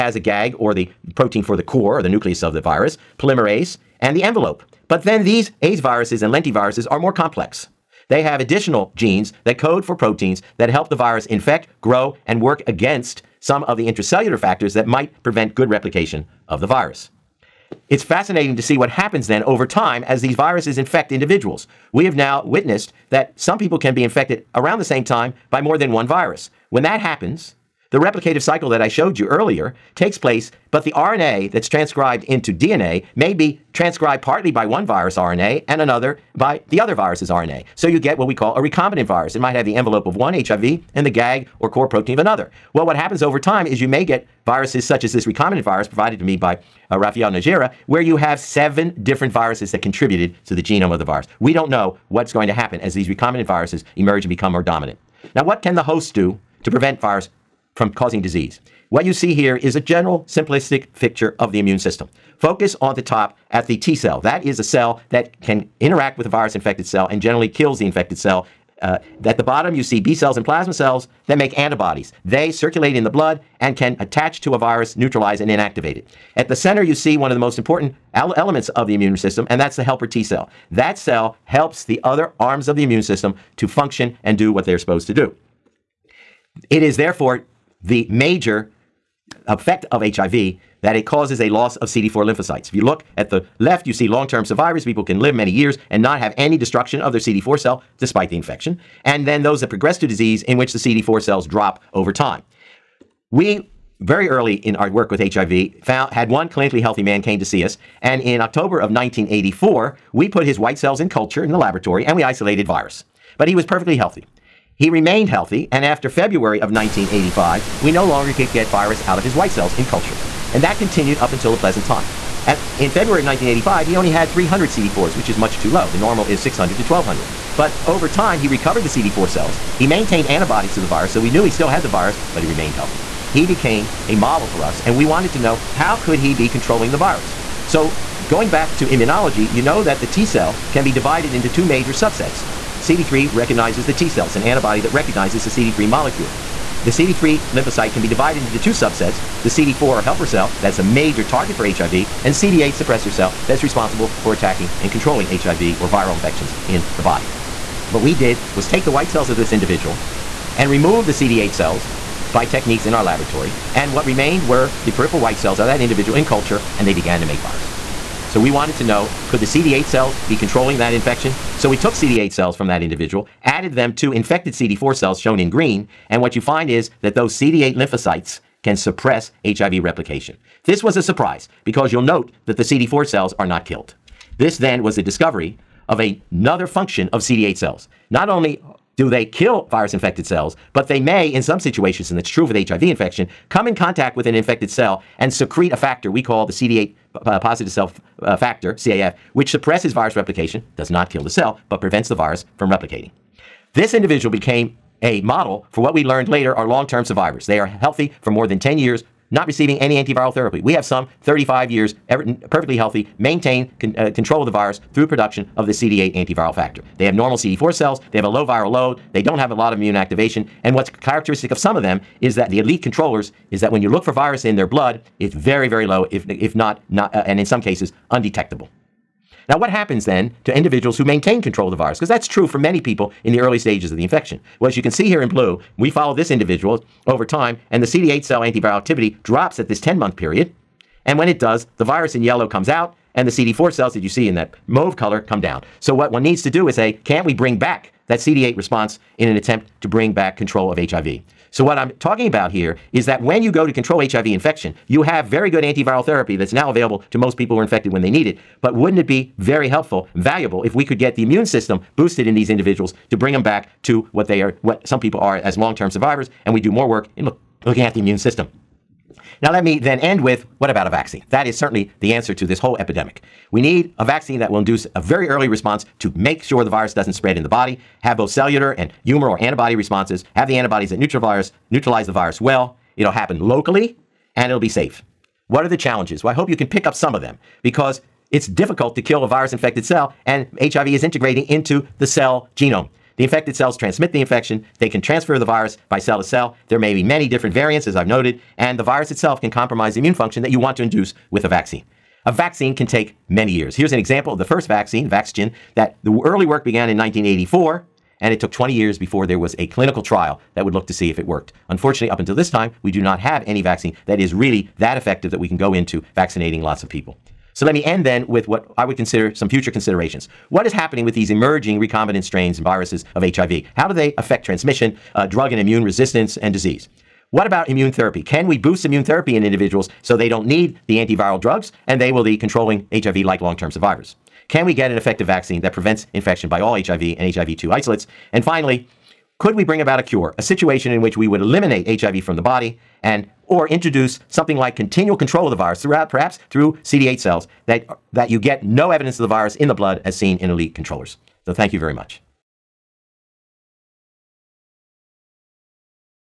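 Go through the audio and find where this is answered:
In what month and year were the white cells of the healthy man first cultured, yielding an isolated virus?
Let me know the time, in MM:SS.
01:48.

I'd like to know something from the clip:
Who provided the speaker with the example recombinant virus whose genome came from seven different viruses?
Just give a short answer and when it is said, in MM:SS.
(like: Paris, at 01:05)
Rafael Najera, at 00:46.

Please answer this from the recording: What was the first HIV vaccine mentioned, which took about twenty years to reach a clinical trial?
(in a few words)
Vaxgen.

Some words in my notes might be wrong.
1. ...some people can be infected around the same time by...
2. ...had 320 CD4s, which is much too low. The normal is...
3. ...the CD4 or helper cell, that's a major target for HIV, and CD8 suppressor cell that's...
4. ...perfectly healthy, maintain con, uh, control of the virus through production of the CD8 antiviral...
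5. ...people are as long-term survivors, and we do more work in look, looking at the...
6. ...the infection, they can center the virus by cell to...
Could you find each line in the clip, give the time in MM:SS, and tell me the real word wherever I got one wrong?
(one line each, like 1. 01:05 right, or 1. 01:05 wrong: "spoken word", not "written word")
1. 00:23 right
2. 02:04 wrong: "300", not "320"
3. 02:29 right
4. 03:32 right
5. 04:24 right
6. 04:54 wrong: "transfer", not "center".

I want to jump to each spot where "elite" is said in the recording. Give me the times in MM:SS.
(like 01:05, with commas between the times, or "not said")
03:42, 05:50.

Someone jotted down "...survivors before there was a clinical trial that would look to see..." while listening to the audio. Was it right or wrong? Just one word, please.
wrong.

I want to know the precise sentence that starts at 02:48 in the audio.
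So we wanted to know could the CD8 cells be controlling that infection?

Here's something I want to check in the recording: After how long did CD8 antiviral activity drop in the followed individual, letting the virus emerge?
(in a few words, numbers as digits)
10 months.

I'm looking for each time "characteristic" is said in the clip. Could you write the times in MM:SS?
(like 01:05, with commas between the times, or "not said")
03:40.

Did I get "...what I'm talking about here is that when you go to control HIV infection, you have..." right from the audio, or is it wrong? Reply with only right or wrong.
right.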